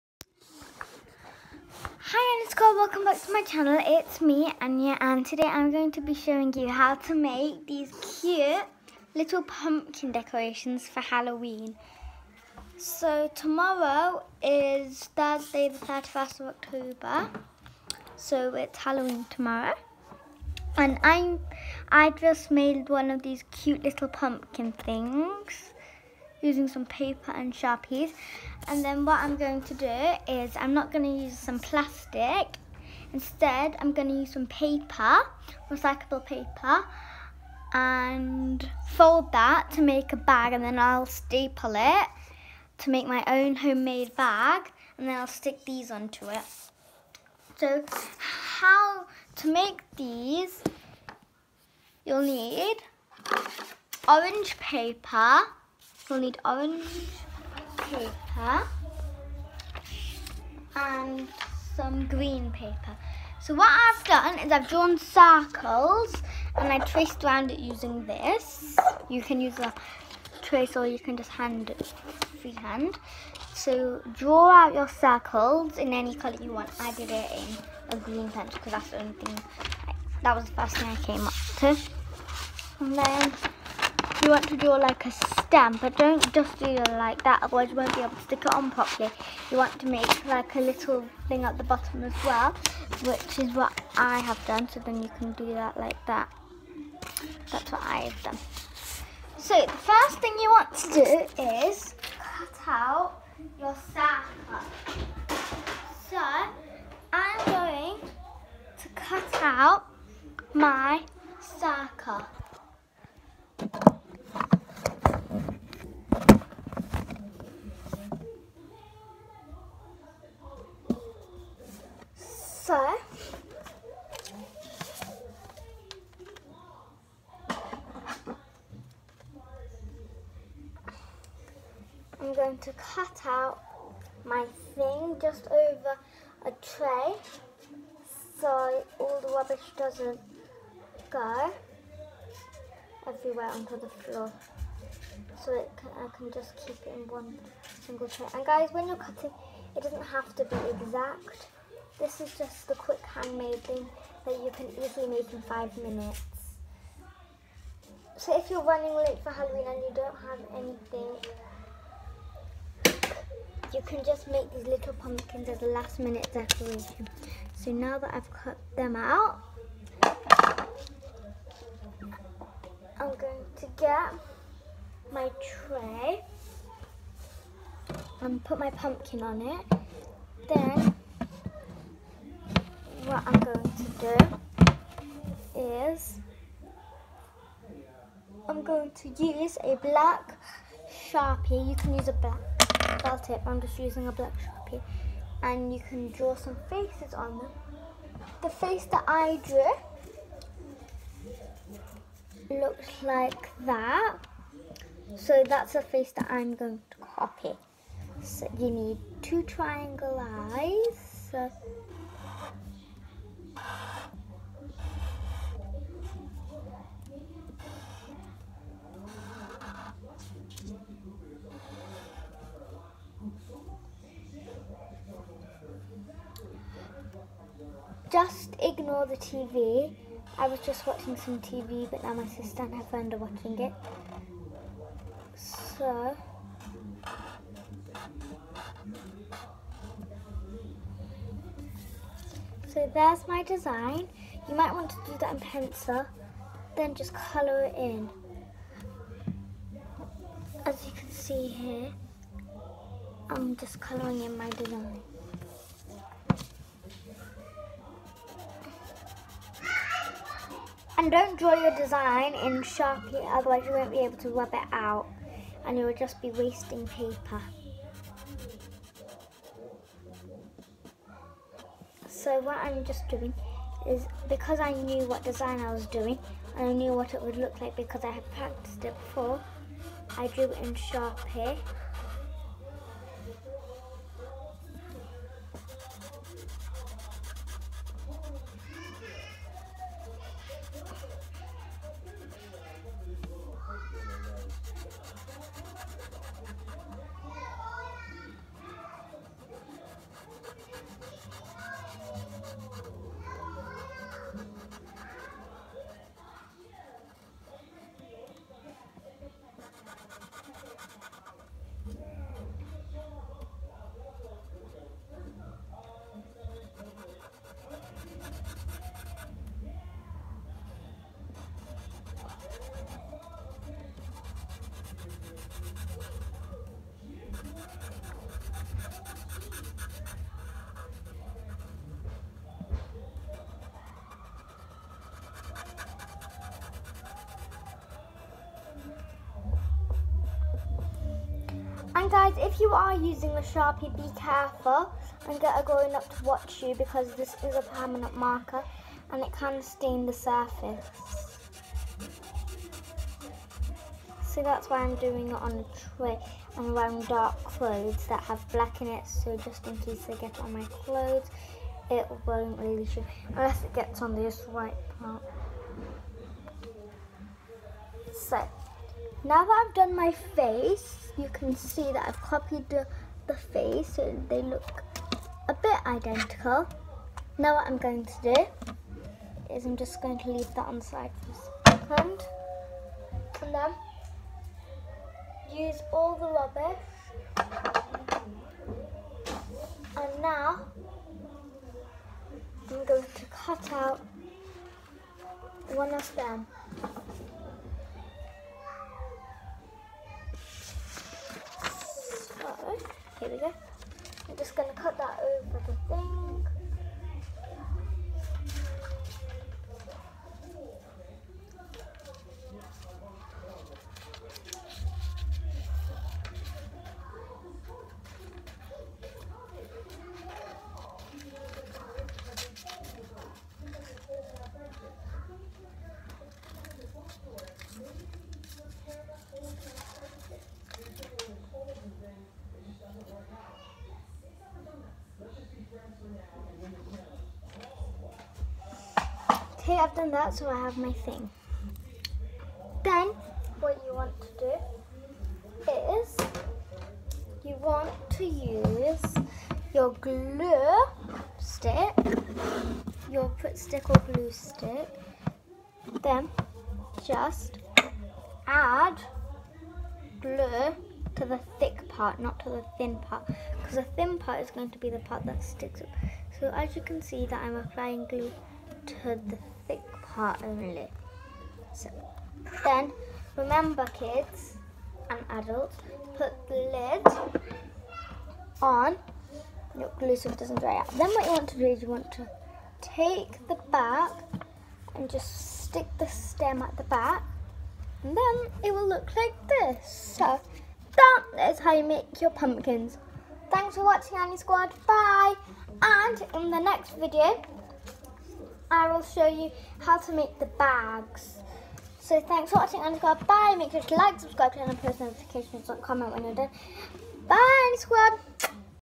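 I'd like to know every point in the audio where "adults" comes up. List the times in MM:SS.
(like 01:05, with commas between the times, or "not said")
07:55.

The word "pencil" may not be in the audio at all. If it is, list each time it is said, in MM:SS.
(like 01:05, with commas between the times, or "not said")
01:18, 04:05.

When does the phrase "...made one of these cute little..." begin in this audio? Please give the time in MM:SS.
00:22.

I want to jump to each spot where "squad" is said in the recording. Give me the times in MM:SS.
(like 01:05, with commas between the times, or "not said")
00:02, 08:14, 08:22, 08:27.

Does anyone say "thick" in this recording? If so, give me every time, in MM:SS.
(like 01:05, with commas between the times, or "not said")
07:41, 07:49.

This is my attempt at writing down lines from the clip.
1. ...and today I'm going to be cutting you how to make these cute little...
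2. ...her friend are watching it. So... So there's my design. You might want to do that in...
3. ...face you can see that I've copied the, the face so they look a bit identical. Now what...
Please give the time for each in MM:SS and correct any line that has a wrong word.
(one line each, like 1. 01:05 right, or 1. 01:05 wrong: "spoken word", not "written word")
1. 00:04 wrong: "showing", not "cutting"
2. 03:52 right
3. 06:10 right.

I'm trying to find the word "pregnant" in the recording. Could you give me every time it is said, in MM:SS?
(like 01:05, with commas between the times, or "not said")
not said.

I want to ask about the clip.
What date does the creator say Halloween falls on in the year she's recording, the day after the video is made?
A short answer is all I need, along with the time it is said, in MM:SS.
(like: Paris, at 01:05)
Thursday the 31st of October, at 00:15.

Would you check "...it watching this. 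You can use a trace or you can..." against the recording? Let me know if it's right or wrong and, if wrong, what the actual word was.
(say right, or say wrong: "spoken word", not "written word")
wrong: "using", not "watching".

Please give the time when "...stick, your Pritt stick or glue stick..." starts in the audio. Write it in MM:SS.
07:31.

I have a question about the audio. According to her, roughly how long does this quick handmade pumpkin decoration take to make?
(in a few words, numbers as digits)
5 minutes.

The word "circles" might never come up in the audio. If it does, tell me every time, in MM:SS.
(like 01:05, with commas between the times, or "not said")
01:04, 01:14, 01:43, 01:51.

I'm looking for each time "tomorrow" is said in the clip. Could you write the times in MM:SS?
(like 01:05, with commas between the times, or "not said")
00:13, 00:19.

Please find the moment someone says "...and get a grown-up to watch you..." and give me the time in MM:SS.
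05:45.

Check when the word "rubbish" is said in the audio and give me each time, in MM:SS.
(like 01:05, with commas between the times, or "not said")
02:19, 06:26.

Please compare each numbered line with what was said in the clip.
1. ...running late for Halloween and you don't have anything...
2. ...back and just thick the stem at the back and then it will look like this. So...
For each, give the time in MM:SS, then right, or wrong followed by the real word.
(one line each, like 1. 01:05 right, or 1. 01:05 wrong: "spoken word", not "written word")
1. 02:38 right
2. 08:03 wrong: "stick", not "thick".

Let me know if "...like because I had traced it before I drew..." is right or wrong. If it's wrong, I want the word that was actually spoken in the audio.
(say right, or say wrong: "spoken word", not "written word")
wrong: "practiced", not "traced".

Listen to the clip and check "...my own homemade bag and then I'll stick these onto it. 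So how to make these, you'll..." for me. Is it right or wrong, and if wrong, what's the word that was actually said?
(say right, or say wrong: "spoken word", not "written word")
right.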